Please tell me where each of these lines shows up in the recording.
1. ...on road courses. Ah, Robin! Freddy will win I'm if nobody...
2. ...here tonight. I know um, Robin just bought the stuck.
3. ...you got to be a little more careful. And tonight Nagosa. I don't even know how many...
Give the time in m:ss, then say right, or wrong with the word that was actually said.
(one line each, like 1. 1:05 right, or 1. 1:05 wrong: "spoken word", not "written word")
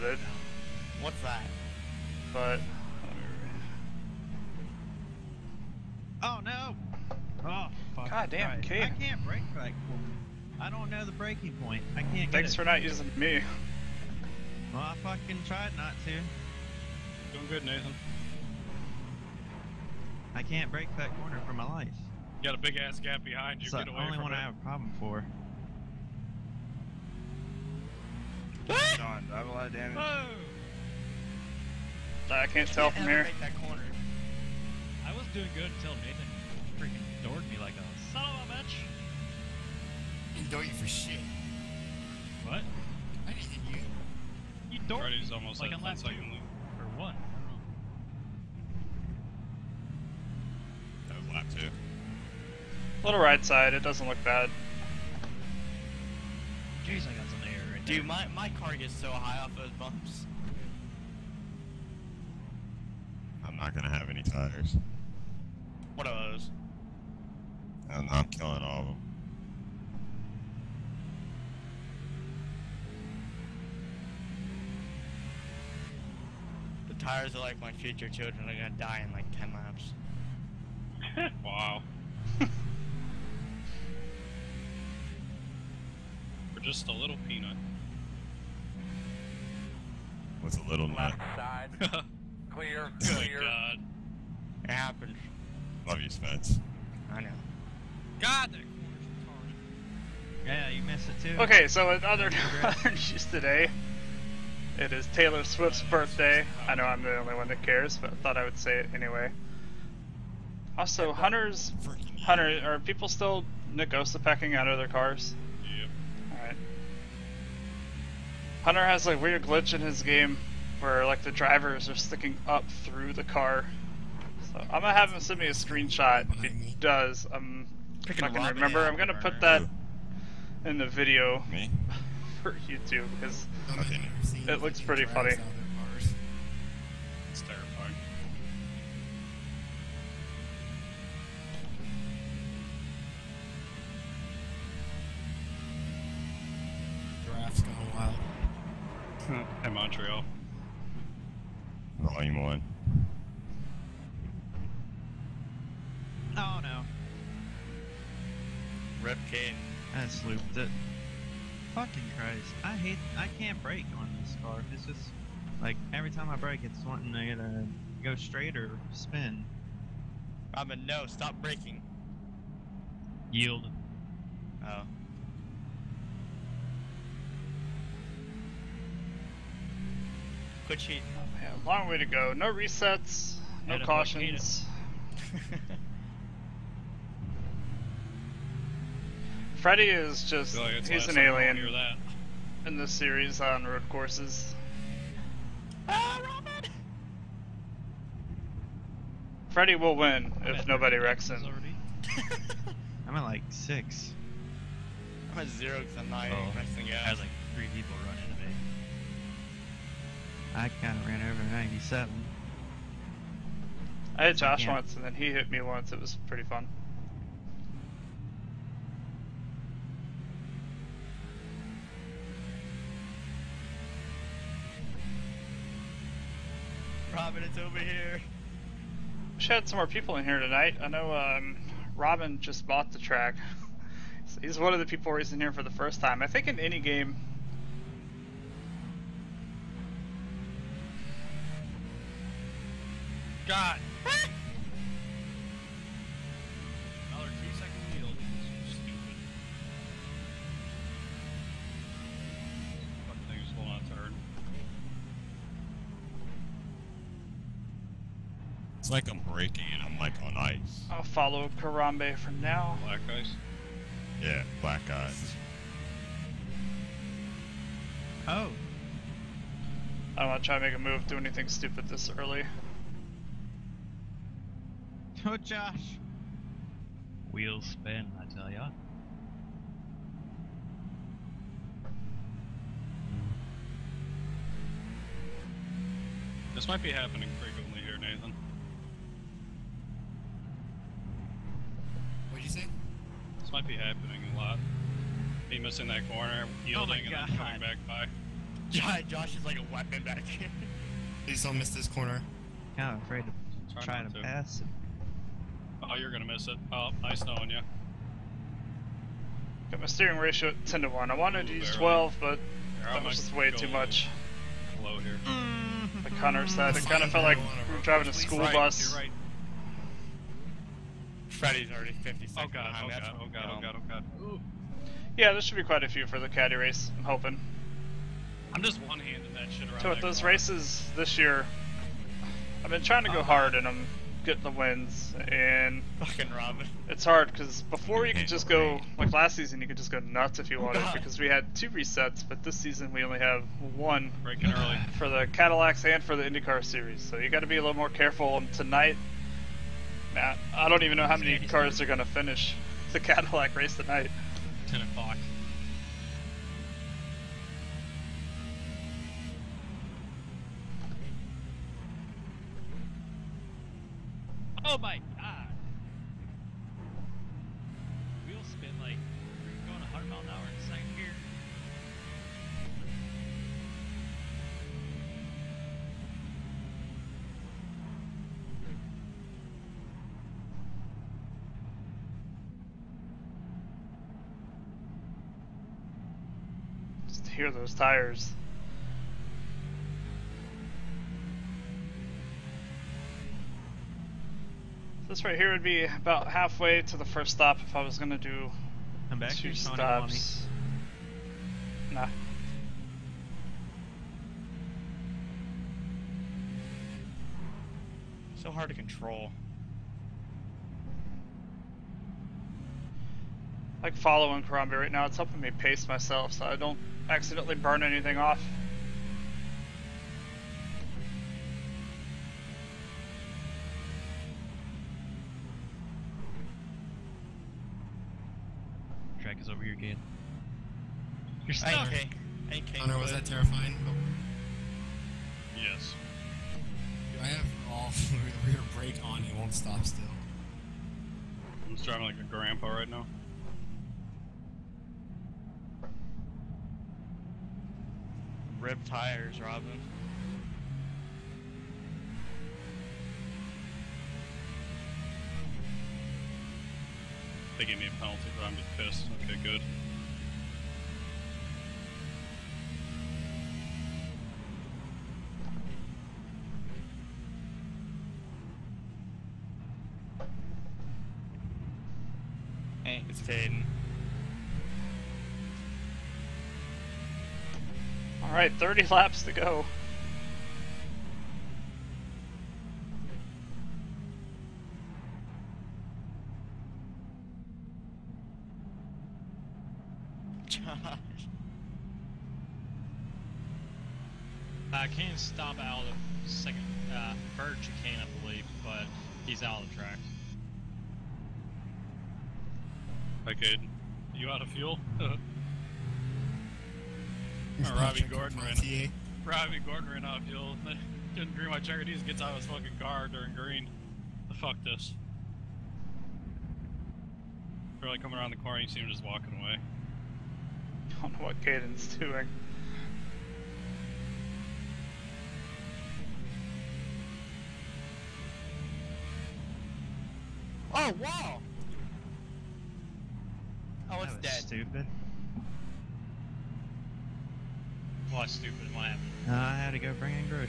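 1. 3:13 right
2. 3:50 wrong: "track", not "stuck"
3. 5:47 wrong: "Matt", not "Nagosa".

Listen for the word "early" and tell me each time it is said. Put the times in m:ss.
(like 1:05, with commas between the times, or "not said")
4:32, 5:44.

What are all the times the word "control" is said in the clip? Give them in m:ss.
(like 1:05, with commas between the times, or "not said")
6:48.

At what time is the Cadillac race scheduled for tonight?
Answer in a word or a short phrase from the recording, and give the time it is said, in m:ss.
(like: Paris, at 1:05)
10 o'clock, at 5:54.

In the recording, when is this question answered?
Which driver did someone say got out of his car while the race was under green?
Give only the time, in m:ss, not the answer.
8:31.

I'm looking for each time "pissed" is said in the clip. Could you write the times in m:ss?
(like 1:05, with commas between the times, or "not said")
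7:38.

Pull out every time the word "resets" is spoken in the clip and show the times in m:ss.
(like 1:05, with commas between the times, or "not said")
3:02, 5:41.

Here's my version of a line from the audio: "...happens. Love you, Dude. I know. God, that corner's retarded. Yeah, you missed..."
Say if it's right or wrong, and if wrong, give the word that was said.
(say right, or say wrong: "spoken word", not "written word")
wrong: "Spence", not "Dude".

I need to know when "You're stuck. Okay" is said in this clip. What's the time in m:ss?
7:11.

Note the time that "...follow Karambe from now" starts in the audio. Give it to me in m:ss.
4:21.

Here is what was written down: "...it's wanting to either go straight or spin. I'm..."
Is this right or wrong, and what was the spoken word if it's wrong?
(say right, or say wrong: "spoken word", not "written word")
right.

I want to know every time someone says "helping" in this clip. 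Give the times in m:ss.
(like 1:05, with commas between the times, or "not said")
6:55.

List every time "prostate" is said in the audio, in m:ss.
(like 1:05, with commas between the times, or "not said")
not said.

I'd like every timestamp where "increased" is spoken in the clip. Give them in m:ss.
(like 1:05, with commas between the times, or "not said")
not said.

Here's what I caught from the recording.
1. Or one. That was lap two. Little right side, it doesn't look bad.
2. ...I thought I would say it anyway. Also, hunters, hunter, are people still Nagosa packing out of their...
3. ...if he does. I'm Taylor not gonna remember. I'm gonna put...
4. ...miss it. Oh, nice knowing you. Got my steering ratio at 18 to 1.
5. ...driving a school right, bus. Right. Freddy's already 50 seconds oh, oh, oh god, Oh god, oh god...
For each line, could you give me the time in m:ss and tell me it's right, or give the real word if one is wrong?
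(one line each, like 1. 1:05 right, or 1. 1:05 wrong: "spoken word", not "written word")
1. 0:46 right
2. 1:48 right
3. 2:06 wrong: "Freaking", not "Taylor"
4. 5:06 wrong: "10", not "18"
5. 5:17 right.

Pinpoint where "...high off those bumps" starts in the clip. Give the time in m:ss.
0:59.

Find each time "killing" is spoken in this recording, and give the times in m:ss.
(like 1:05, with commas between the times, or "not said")
1:08.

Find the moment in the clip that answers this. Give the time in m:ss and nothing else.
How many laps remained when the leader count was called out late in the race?
7:58.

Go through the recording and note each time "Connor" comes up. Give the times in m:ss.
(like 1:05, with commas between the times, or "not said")
5:16, 7:12.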